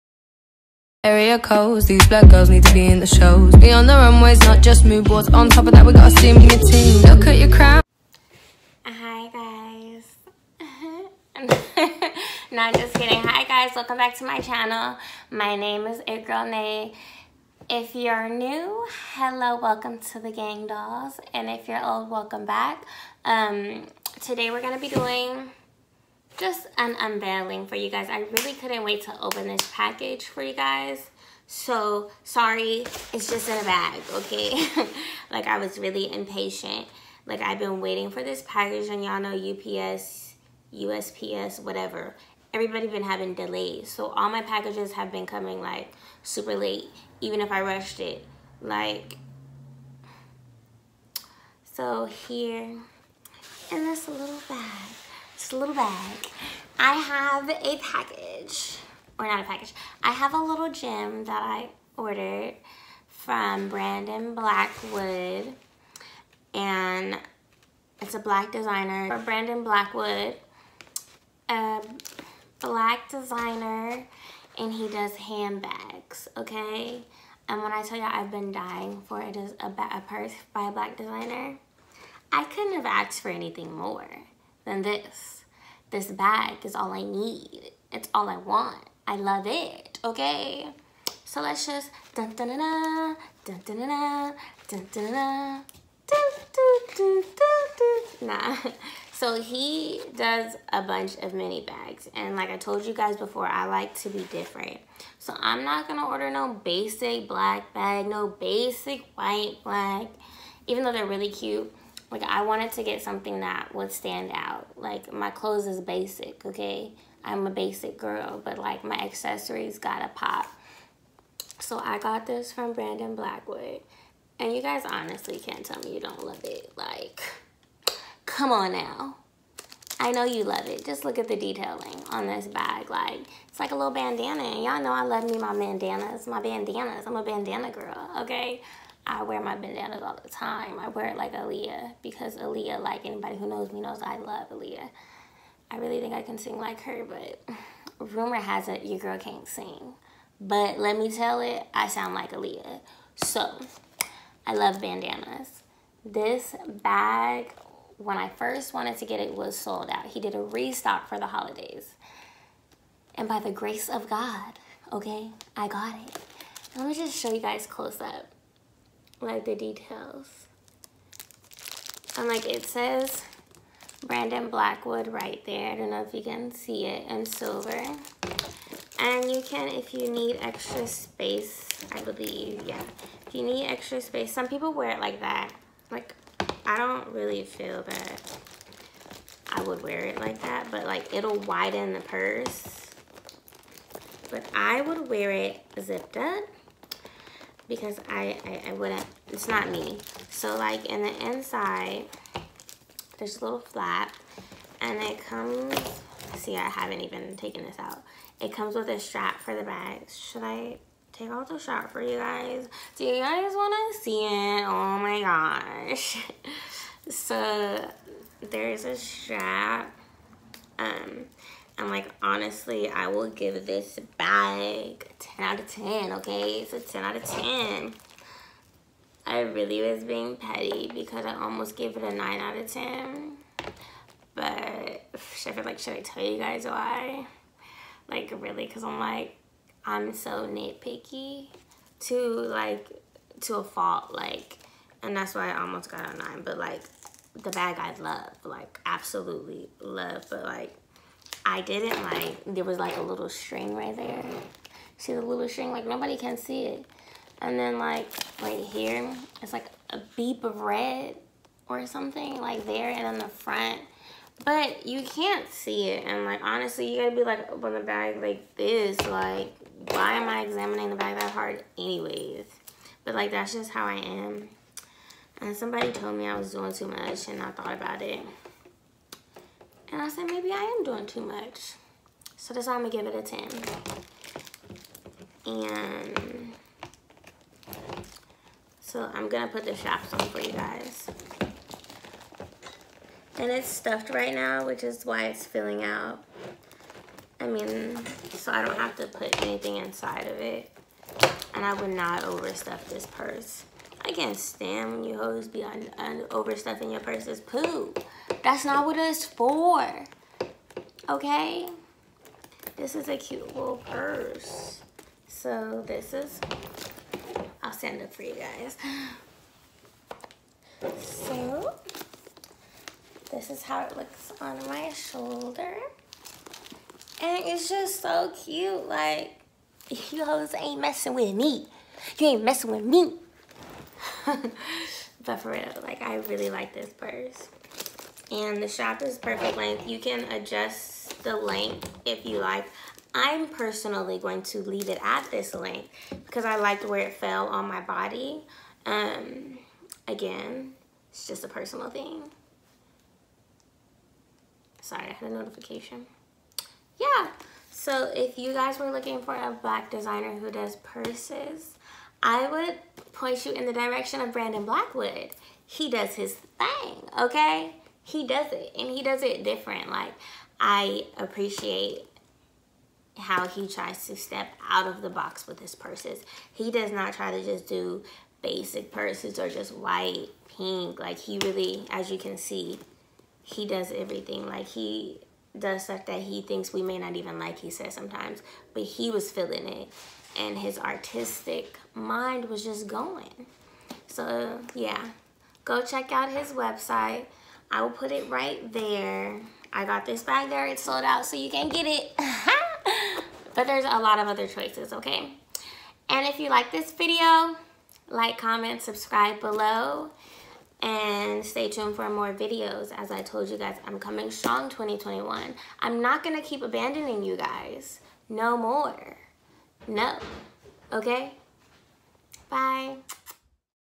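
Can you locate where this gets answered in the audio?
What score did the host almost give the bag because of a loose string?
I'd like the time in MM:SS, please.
03:52.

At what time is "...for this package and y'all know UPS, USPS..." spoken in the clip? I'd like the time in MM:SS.
00:38.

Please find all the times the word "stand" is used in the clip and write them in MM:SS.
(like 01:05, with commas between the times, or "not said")
01:53, 05:04, 05:17.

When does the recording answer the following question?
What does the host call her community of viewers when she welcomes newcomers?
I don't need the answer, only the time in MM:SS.
00:20.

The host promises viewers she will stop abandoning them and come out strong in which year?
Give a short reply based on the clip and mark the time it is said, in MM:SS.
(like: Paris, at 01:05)
2021, at 06:54.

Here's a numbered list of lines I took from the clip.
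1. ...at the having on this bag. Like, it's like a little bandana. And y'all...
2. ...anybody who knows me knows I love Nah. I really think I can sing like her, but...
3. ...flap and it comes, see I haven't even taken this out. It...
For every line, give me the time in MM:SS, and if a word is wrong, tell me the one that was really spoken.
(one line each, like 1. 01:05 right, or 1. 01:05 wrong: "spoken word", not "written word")
1. 02:11 wrong: "detailing", not "having"
2. 02:23 wrong: "Aaliyah", not "Nah"
3. 03:23 right.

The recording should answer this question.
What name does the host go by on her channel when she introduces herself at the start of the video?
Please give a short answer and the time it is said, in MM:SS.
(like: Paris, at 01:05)
It Girl Nae, at 00:16.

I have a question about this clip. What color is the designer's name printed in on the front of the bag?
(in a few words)
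silver.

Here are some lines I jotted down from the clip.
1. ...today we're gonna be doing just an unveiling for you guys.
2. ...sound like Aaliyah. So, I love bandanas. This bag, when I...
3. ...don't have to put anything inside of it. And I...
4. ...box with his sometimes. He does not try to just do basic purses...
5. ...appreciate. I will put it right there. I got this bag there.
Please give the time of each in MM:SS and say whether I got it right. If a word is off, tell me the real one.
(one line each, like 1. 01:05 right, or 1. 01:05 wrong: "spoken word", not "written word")
1. 00:24 right
2. 02:31 right
3. 04:58 right
4. 06:15 wrong: "purses", not "sometimes"
5. 06:36 wrong: "website", not "appreciate".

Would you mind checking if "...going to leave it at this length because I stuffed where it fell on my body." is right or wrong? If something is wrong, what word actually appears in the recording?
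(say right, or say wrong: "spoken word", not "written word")
wrong: "liked", not "stuffed".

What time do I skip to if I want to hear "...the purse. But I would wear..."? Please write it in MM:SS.
03:11.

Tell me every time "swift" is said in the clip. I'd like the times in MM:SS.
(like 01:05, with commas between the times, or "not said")
not said.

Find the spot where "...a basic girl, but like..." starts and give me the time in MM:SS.
01:57.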